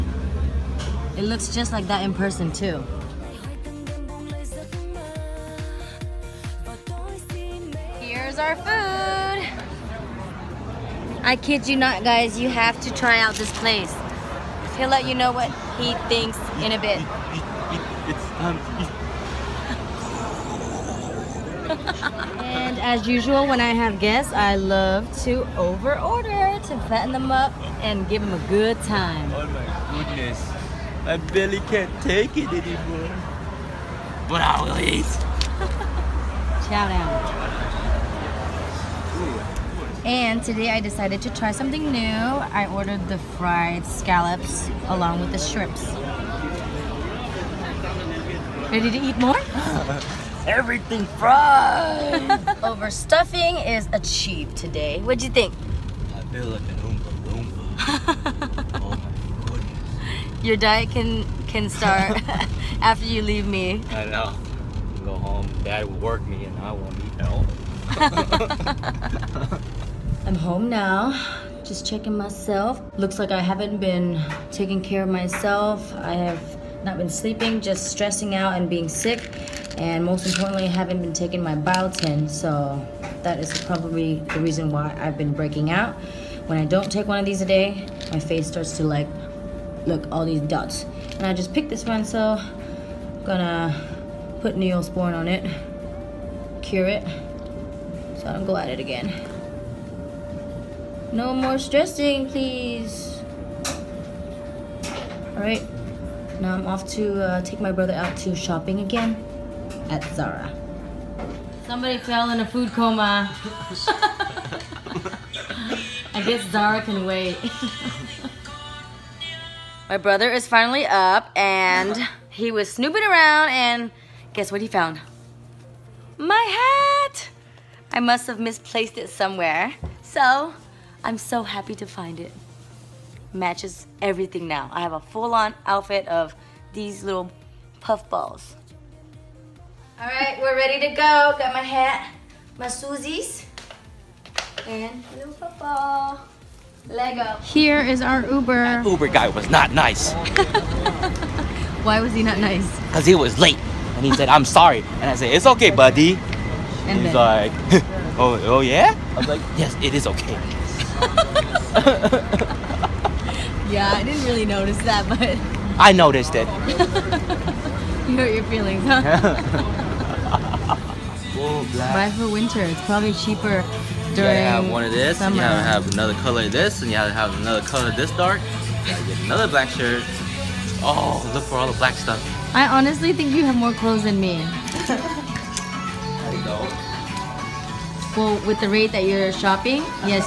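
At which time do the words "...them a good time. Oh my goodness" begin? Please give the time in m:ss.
0:28.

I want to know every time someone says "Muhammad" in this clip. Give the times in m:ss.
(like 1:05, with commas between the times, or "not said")
not said.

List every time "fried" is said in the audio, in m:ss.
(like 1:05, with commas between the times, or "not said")
0:43, 0:51.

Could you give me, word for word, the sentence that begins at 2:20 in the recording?
All right, we're ready to go.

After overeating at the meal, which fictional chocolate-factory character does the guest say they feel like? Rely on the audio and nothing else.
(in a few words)
Oompa Loompa.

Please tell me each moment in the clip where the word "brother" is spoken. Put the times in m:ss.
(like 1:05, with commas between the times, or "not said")
1:47, 1:59.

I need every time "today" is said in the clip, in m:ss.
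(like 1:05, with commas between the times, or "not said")
0:40, 0:54.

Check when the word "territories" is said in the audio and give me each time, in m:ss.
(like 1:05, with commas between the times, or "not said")
not said.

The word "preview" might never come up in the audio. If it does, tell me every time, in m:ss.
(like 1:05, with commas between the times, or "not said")
not said.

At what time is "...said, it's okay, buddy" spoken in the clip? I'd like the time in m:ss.
2:35.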